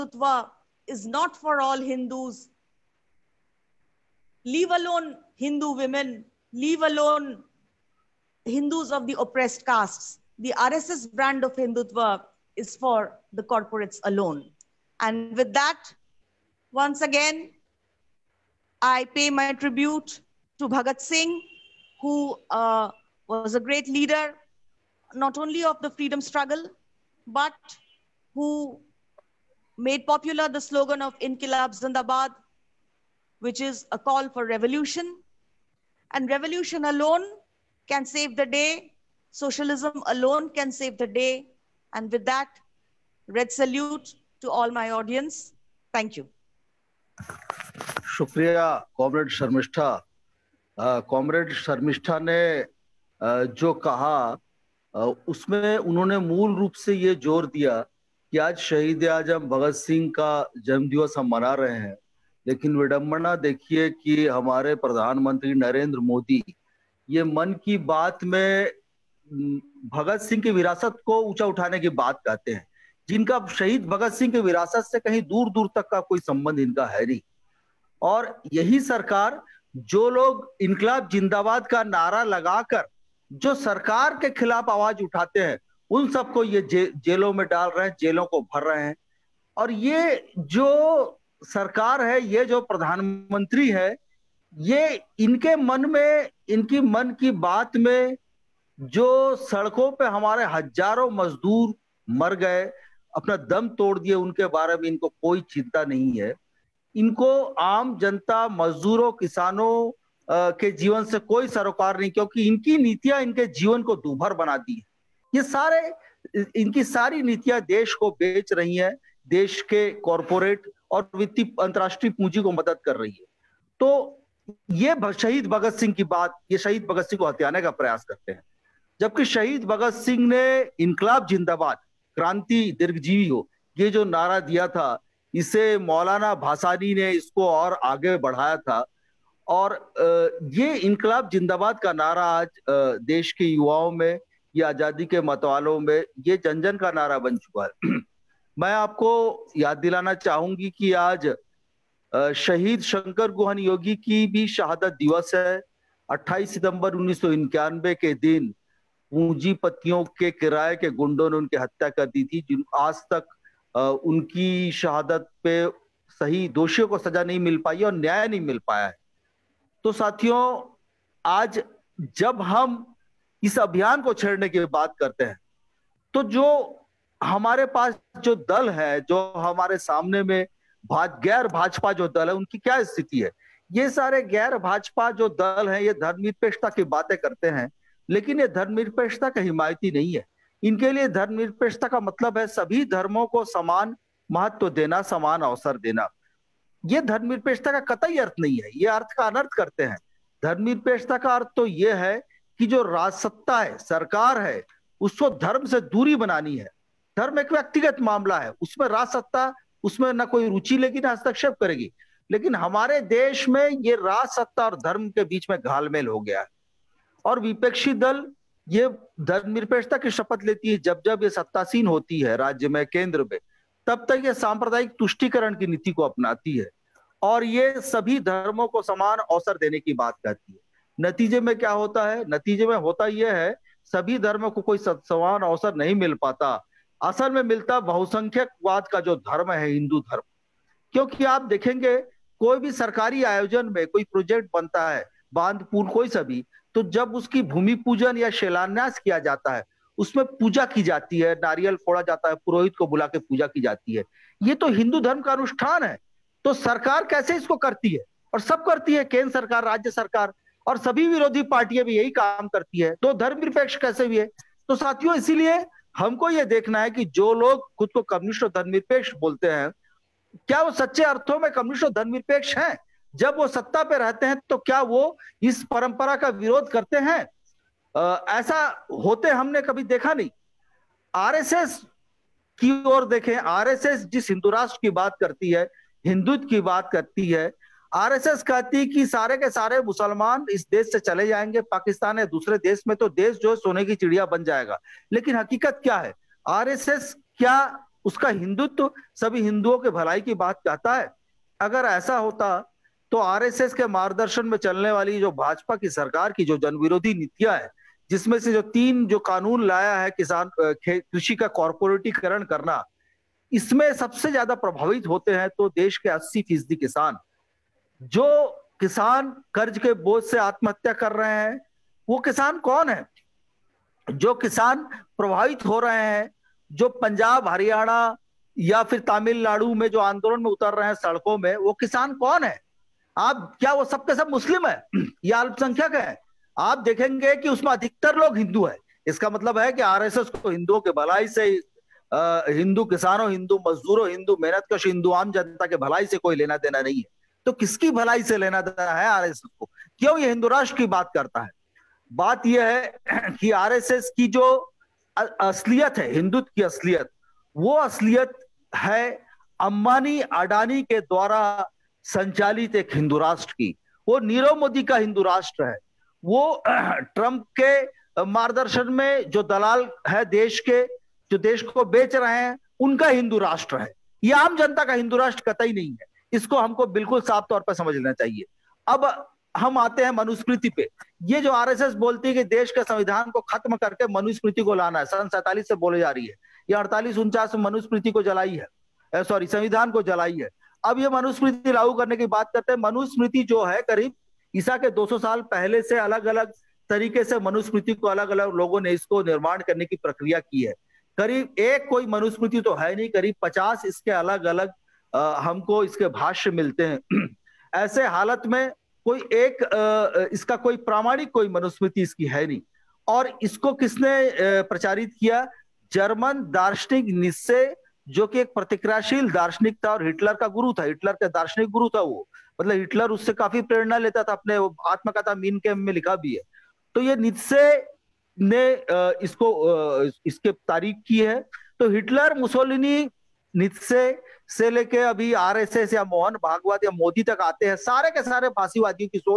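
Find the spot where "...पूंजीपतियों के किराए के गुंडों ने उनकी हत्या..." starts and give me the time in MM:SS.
02:39.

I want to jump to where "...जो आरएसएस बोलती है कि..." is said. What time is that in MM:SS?
06:21.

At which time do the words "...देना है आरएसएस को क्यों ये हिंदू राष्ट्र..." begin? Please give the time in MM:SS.
05:48.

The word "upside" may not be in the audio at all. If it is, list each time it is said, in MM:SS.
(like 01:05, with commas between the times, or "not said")
not said.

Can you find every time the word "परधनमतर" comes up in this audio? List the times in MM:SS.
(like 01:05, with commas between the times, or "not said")
01:04, 01:32.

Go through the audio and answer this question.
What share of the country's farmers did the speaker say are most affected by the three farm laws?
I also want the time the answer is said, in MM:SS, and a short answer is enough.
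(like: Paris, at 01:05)
80 percent, at 05:16.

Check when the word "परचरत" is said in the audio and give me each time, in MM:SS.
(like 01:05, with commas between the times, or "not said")
06:54.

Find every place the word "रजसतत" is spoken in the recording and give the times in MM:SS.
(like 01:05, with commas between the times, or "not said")
03:22, 03:28.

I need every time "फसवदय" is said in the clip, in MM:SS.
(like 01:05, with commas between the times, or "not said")
07:18.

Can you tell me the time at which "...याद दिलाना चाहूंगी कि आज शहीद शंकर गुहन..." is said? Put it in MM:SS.
02:29.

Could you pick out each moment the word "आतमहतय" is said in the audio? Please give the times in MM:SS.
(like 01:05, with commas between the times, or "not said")
05:20.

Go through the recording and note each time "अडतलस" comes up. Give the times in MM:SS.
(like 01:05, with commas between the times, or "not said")
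06:26.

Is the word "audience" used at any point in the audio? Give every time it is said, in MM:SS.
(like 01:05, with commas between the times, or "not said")
00:44.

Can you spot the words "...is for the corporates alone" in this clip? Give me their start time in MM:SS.
00:12.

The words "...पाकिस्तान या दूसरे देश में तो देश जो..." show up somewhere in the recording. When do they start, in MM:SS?
04:51.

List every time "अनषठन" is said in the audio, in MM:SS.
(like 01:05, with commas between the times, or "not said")
04:15.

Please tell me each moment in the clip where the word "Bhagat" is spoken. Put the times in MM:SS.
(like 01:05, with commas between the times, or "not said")
00:20.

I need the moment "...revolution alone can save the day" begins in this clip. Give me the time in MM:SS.
00:36.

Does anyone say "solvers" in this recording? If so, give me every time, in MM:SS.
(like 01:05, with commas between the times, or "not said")
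not said.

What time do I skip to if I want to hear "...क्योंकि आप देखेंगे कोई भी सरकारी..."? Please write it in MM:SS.
04:00.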